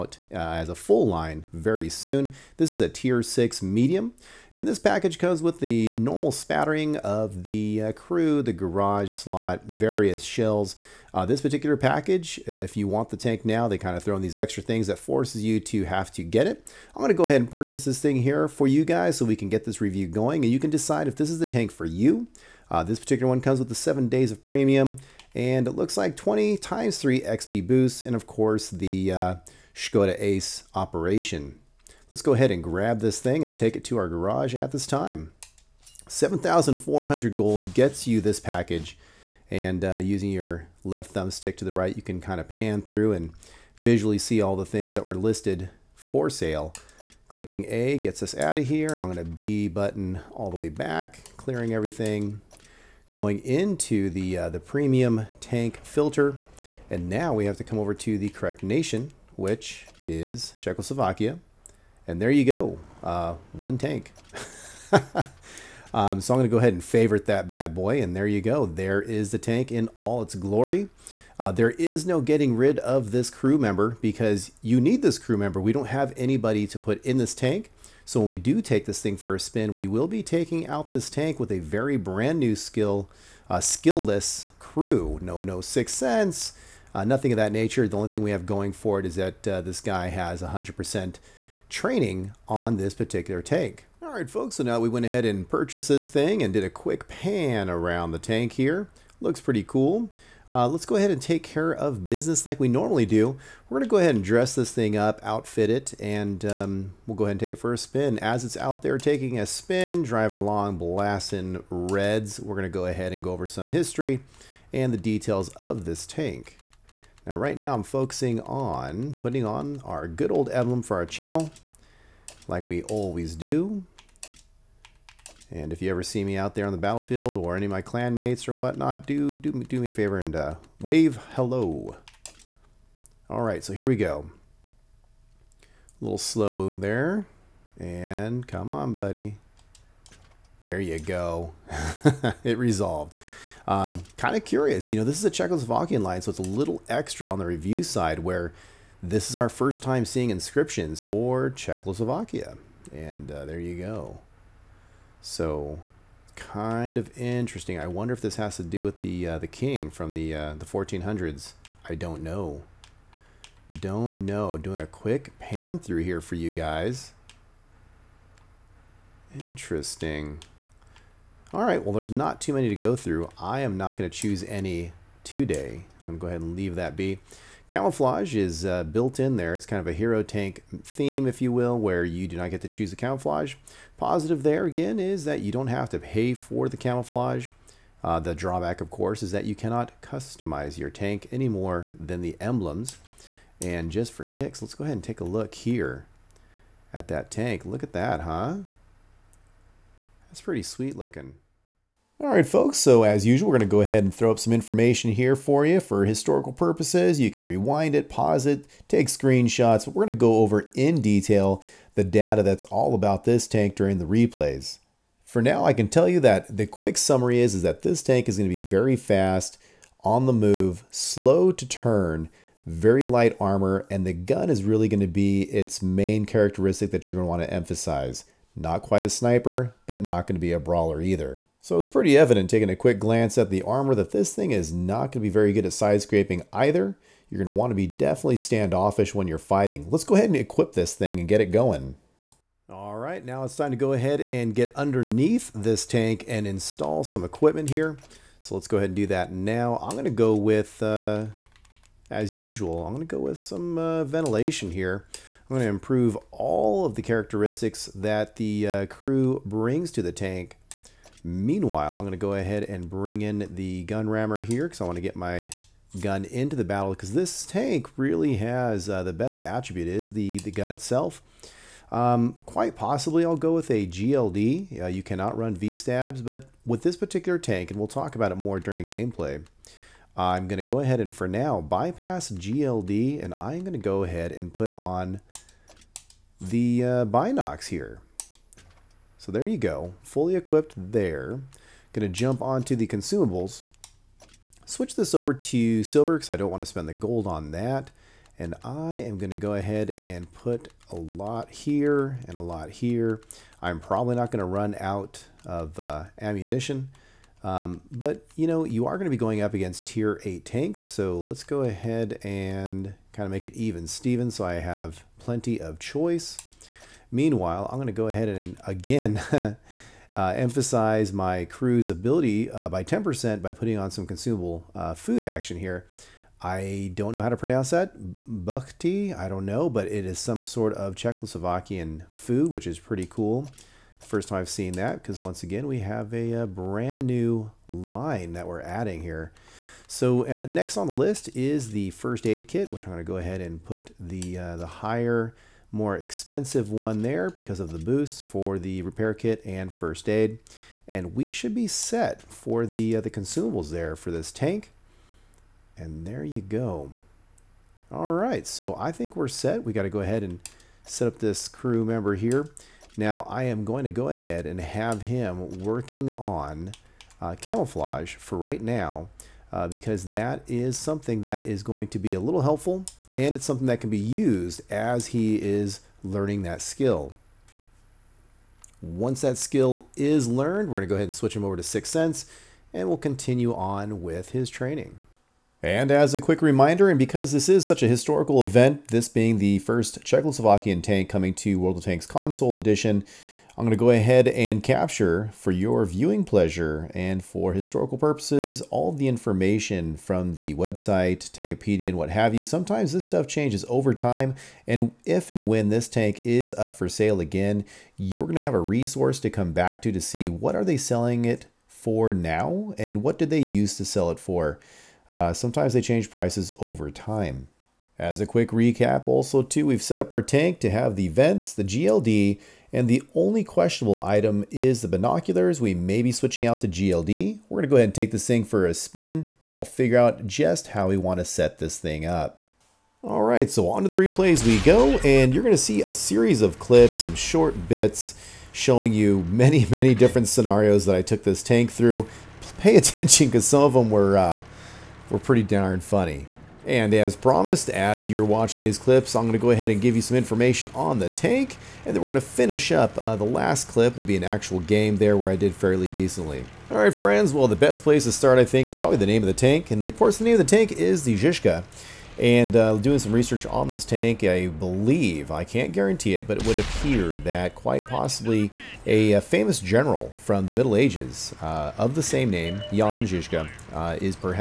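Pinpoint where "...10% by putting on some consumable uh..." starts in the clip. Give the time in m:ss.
5:22.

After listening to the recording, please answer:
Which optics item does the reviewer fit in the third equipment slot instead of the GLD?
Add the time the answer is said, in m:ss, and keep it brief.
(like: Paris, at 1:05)
Binoculars, at 4:47.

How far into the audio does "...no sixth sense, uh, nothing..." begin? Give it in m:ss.
1:25.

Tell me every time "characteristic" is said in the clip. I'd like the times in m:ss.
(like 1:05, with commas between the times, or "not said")
3:46, 4:17.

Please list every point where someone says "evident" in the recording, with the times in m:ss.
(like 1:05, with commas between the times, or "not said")
3:52.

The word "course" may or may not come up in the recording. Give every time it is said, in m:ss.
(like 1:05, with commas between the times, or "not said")
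0:28, 3:08, 7:39.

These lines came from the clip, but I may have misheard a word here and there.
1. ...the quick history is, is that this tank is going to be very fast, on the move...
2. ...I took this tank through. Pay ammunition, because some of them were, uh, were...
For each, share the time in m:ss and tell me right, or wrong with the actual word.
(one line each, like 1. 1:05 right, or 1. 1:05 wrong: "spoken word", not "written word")
1. 3:36 wrong: "summary", not "history"
2. 7:20 wrong: "attention", not "ammunition".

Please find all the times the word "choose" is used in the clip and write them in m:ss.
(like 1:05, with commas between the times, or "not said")
2:54, 3:02.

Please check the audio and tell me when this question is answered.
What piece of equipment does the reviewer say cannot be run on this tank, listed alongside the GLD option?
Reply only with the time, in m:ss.
4:35.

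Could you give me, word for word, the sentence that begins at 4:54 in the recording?
Switch this over to silver because I don't want to spend the gold on that.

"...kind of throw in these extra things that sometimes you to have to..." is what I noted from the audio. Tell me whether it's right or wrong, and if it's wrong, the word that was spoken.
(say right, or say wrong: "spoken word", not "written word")
wrong: "forces", not "sometimes".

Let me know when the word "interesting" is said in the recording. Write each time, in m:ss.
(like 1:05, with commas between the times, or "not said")
2:37, 2:49.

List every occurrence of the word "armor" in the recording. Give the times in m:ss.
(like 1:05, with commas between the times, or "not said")
3:43, 3:53.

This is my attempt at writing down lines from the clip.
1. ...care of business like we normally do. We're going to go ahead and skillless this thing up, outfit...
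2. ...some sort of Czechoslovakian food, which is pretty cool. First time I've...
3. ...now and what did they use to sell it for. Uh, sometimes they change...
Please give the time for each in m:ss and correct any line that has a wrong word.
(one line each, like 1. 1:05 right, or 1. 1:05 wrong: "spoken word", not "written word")
1. 1:41 wrong: "dress", not "skillless"
2. 5:30 right
3. 6:52 right.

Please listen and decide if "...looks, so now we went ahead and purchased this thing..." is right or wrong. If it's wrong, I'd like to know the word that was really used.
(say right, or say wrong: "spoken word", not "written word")
wrong: "folks", not "looks".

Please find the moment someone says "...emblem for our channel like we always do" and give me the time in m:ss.
2:00.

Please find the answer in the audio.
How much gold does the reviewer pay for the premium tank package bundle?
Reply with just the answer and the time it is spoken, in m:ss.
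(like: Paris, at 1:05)
7,400 gold, at 0:36.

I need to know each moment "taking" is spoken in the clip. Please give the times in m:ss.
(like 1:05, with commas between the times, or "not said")
1:20, 1:48, 3:52.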